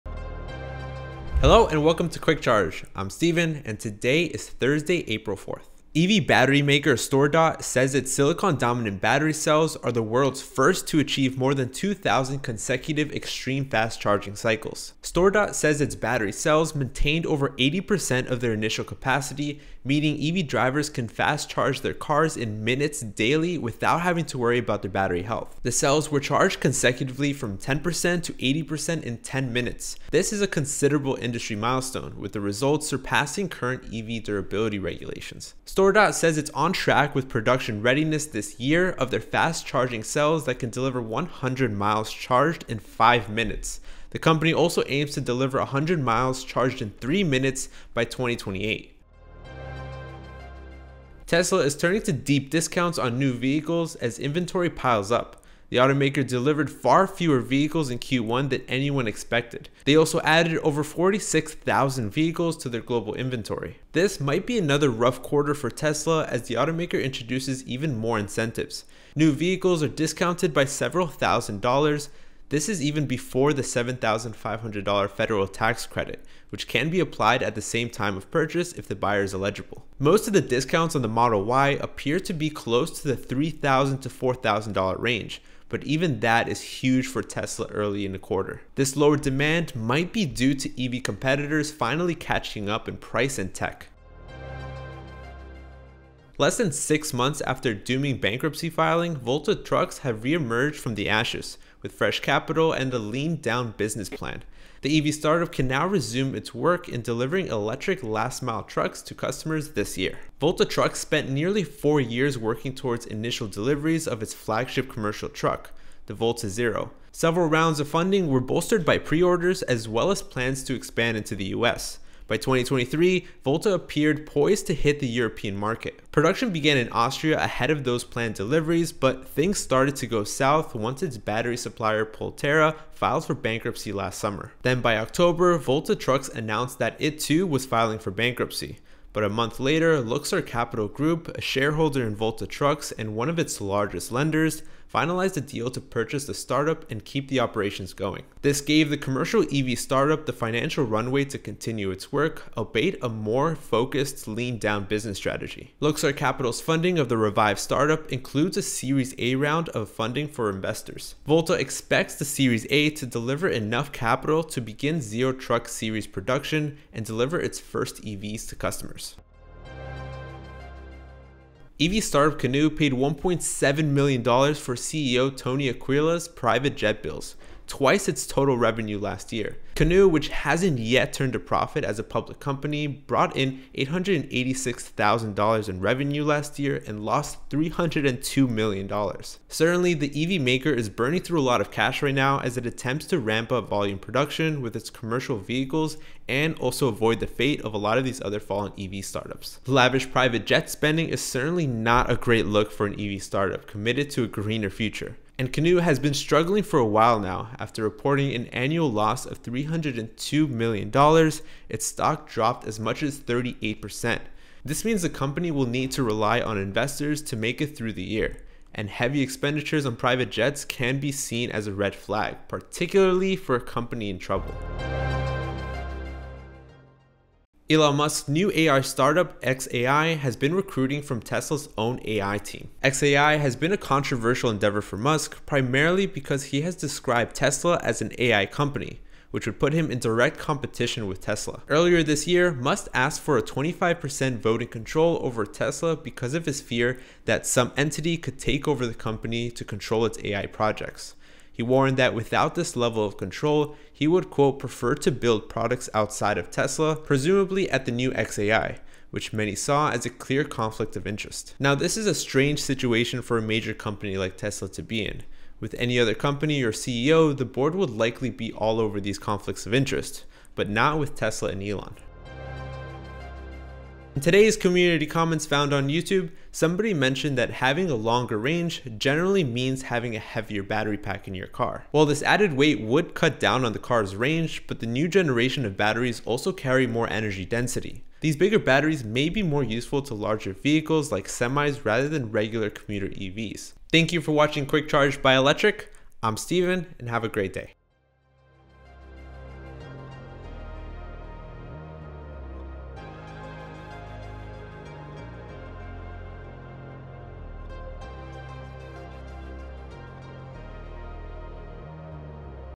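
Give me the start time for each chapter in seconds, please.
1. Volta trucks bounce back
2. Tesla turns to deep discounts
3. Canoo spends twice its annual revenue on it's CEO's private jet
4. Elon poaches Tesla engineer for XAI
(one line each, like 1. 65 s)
1. 95 s
2. 51 s
3. 170 s
4. 226 s.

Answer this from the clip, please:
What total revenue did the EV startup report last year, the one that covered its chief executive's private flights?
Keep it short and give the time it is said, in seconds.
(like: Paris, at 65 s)
$886,000, at 183 s.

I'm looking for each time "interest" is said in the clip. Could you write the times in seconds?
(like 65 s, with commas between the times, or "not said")
261 s, 269 s.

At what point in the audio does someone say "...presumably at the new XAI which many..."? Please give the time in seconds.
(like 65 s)
256 s.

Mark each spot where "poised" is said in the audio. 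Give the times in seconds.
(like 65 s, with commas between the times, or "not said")
124 s.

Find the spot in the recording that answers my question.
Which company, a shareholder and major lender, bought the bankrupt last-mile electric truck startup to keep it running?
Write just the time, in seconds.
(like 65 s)
139 s.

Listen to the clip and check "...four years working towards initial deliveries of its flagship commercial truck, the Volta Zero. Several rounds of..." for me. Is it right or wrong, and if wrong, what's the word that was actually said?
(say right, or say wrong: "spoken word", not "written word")
right.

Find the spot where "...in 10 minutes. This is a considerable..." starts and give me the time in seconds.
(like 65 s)
29 s.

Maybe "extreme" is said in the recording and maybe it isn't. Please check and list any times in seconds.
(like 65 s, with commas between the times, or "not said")
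13 s.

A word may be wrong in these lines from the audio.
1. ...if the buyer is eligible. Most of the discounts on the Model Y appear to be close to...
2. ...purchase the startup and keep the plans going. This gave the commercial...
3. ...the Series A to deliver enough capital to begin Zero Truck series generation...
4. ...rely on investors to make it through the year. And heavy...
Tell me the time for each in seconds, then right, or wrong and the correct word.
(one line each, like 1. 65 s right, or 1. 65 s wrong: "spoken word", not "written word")
1. 78 s right
2. 145 s wrong: "operations", not "plans"
3. 162 s wrong: "production", not "generation"
4. 216 s right.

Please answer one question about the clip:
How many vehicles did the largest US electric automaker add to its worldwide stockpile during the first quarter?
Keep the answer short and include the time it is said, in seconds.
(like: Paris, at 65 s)
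46,000, at 60 s.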